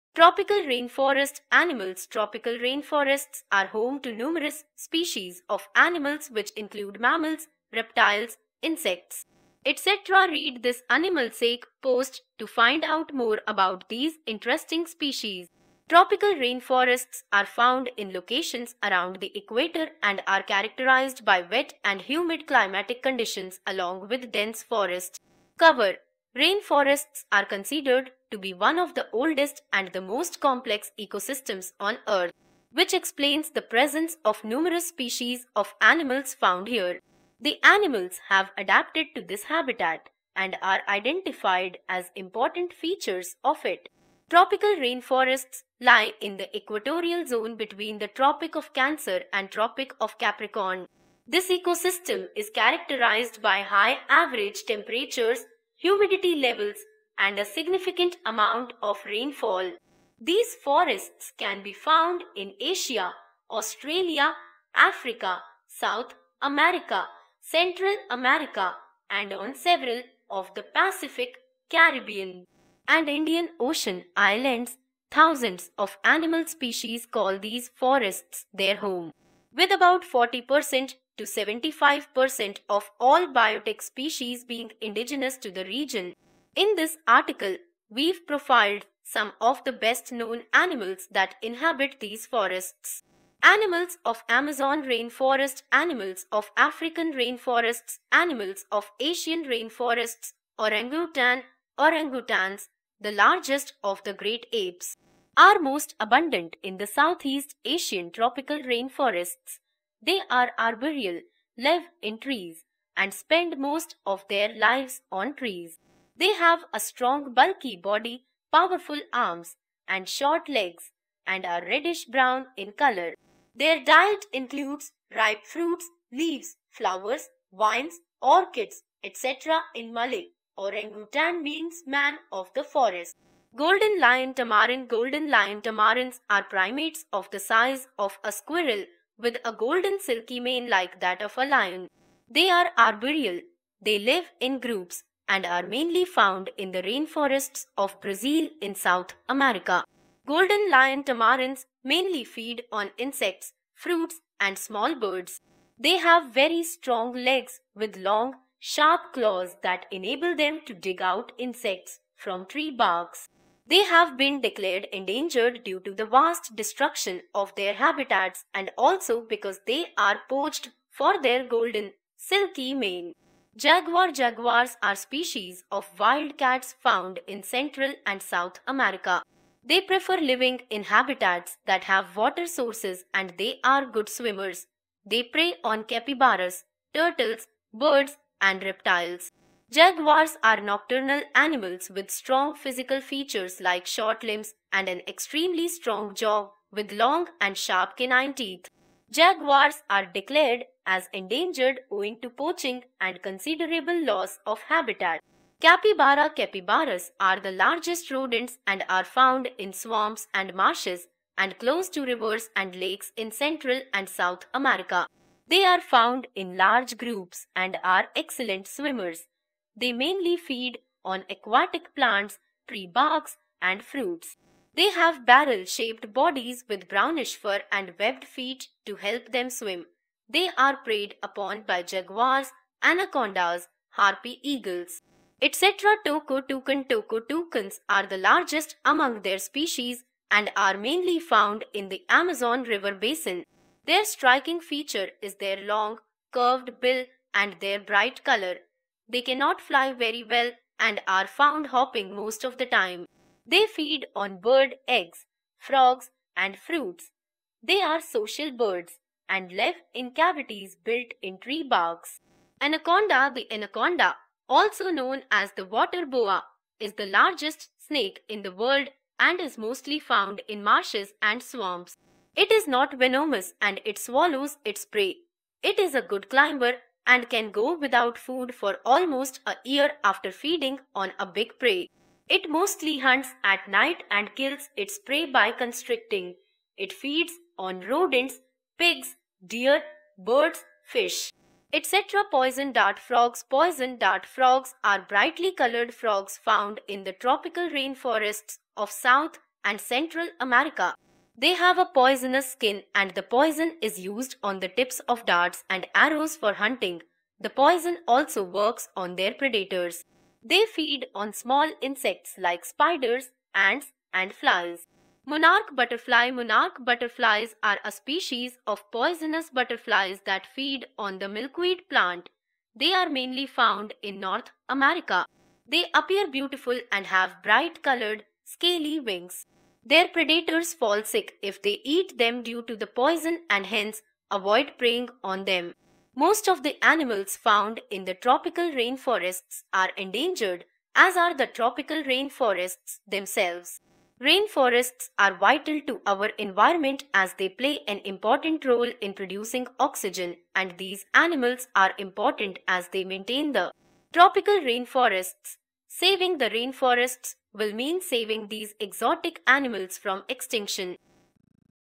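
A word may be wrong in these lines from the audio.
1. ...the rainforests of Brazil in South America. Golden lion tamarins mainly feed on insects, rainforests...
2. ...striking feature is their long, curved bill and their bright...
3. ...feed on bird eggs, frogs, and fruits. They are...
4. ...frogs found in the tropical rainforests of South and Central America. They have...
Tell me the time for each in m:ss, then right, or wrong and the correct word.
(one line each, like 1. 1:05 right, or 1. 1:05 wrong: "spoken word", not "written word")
1. 2:26 wrong: "fruits", not "rainforests"
2. 4:04 right
3. 4:13 right
4. 4:55 right.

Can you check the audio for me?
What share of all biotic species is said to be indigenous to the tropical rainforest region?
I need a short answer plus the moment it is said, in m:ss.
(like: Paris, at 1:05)
40% to 75%, at 1:20.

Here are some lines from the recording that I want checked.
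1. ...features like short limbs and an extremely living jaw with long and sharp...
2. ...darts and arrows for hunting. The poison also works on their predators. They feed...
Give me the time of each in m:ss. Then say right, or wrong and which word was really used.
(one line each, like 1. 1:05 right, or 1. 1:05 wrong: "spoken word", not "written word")
1. 3:13 wrong: "strong", not "living"
2. 5:05 right.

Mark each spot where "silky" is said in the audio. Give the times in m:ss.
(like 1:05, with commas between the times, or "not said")
2:19, 2:52.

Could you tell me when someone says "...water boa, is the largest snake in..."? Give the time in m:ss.
4:25.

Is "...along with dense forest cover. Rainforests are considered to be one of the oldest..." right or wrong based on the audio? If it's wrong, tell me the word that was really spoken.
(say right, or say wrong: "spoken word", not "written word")
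right.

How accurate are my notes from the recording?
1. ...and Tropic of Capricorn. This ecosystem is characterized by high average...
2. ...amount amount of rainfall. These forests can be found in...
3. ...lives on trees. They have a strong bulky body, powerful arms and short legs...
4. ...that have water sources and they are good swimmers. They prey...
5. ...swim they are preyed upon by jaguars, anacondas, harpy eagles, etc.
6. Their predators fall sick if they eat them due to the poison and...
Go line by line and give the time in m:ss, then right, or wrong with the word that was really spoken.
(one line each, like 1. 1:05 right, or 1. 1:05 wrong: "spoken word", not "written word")
1. 0:49 right
2. 0:57 wrong: "significant", not "amount"
3. 1:54 right
4. 3:01 right
5. 3:49 right
6. 5:29 right.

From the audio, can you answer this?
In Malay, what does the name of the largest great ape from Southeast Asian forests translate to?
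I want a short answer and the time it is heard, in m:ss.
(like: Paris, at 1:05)
man of the forest, at 2:11.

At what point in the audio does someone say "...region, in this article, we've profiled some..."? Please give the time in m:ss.
1:25.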